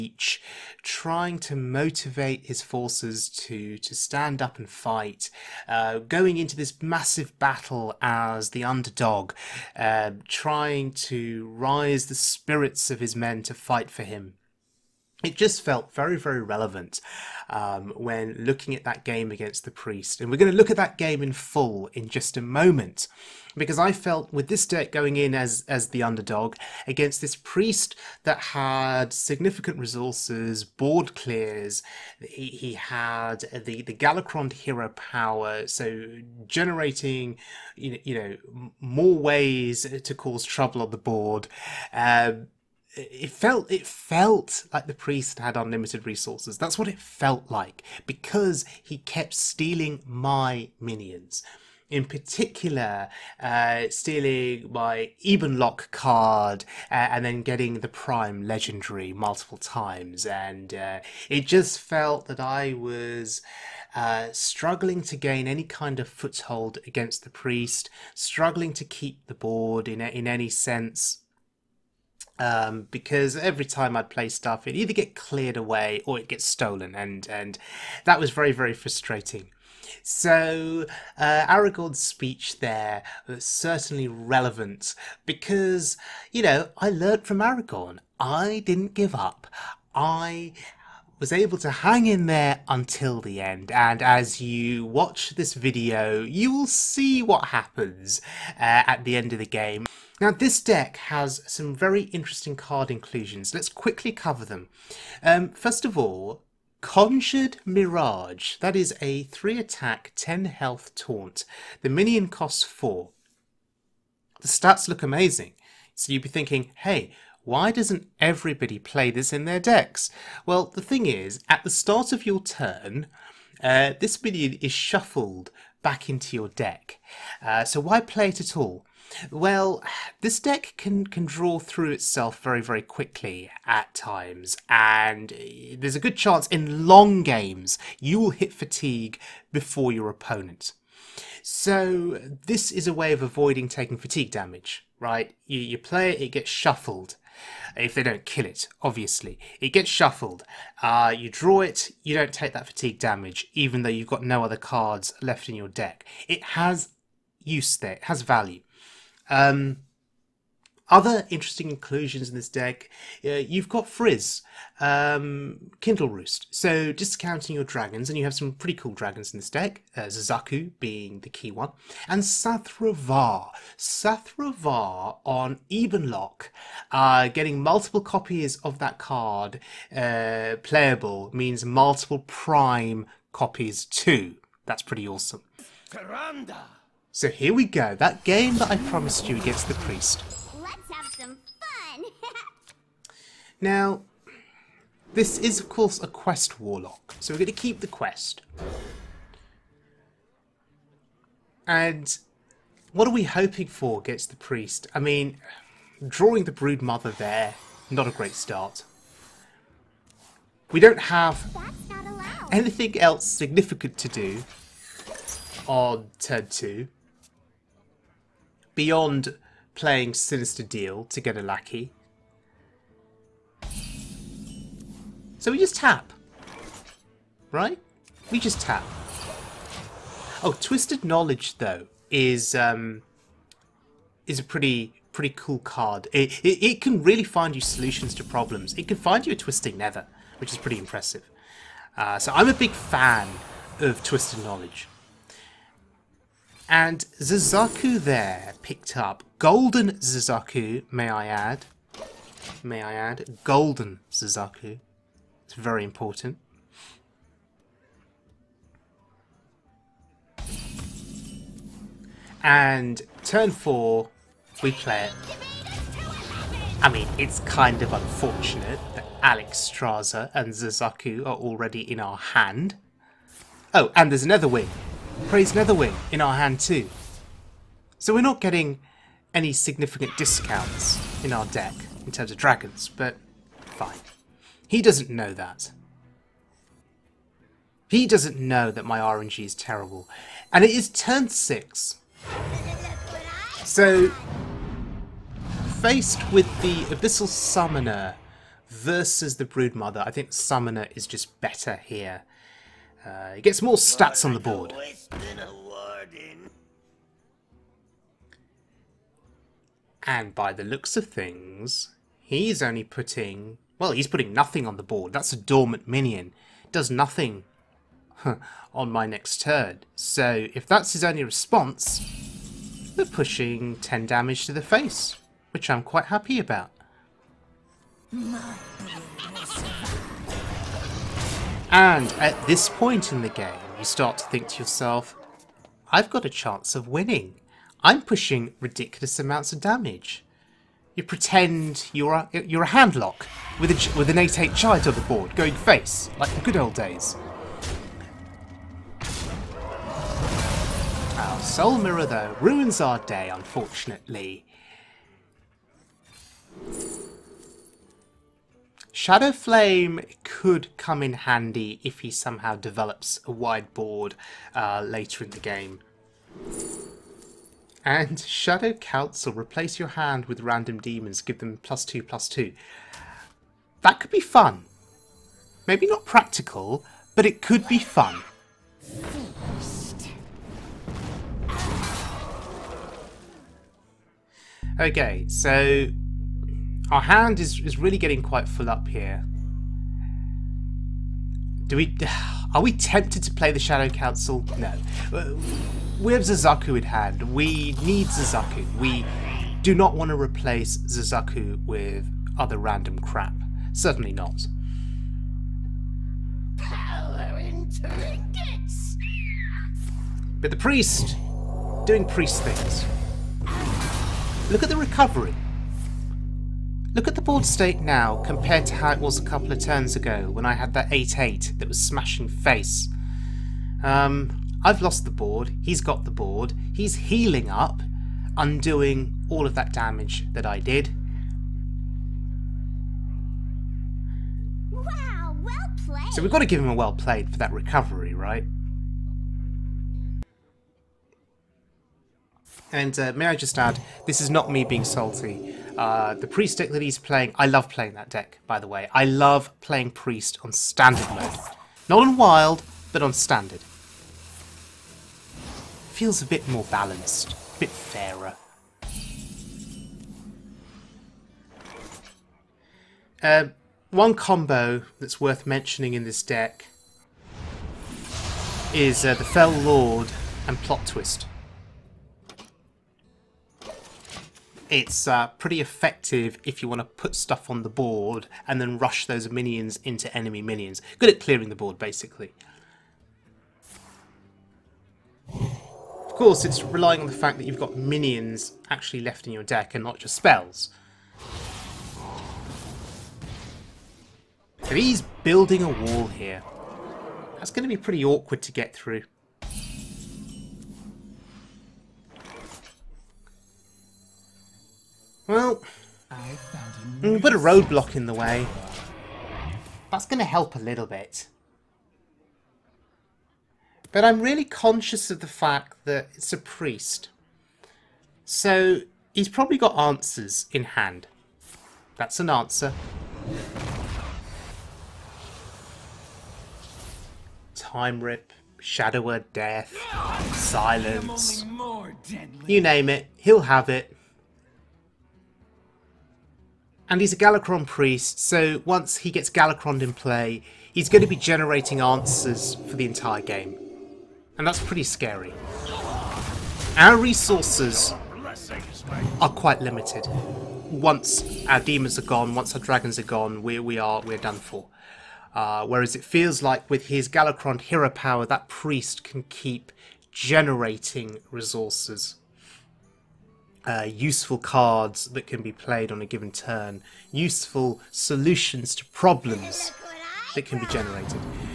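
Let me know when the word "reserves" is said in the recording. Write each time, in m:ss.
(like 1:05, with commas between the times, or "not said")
not said.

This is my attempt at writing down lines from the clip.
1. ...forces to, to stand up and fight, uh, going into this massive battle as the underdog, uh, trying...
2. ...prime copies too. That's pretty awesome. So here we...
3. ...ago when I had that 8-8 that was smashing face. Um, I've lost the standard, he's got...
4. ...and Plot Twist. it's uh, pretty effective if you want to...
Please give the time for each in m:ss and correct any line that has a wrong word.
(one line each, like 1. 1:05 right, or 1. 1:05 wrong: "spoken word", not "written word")
1. 0:02 right
2. 3:02 right
3. 6:59 wrong: "board", not "standard"
4. 7:50 right.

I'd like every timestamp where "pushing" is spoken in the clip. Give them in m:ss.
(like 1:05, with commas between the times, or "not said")
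5:23, 5:38.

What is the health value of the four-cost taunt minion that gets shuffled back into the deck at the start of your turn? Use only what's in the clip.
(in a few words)
10.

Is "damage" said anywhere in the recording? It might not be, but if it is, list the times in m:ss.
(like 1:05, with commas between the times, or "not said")
2:24, 2:32, 5:24, 5:39, 7:09.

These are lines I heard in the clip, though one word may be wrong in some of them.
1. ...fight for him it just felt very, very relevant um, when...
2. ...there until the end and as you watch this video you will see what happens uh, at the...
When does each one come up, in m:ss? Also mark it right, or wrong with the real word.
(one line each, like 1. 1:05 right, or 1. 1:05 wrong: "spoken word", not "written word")
1. 0:13 right
2. 1:32 right.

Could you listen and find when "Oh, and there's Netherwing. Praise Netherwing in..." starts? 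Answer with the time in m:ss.
4:33.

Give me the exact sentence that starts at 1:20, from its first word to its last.
So uh, Aragorn's speech there was certainly relevant because you know I learnt from Aragorn.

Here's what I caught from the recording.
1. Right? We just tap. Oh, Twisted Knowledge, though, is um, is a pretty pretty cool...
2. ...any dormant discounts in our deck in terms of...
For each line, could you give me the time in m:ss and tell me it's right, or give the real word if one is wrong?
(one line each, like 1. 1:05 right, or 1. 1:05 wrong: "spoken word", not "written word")
1. 3:47 right
2. 4:39 wrong: "significant", not "dormant".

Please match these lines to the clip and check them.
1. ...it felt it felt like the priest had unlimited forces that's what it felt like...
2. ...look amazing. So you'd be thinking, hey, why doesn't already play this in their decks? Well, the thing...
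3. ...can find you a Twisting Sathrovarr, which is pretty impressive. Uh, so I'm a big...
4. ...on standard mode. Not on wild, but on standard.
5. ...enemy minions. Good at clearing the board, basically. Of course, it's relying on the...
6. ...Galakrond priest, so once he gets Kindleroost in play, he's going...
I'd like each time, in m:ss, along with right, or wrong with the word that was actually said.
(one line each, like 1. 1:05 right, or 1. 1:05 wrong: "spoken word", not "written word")
1. 0:42 wrong: "resources", not "forces"
2. 1:54 wrong: "everybody", not "already"
3. 3:58 wrong: "Nether", not "Sathrovarr"
4. 7:30 right
5. 8:00 right
6. 8:57 wrong: "Galakrond", not "Kindleroost".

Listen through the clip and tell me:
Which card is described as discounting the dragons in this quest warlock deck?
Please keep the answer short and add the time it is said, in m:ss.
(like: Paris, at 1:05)
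Kindleroost, at 2:45.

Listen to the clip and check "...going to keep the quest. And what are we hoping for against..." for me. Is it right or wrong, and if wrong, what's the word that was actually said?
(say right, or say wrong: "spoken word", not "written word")
right.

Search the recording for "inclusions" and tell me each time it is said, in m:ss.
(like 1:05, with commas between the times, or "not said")
1:42, 2:41.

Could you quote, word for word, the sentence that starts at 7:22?
And uh, may I just add, this is not me being salty.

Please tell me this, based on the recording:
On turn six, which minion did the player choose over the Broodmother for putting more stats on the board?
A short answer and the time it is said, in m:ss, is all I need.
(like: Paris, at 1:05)
Abyssal Summoner, at 4:56.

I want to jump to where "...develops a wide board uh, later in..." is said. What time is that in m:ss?
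6:02.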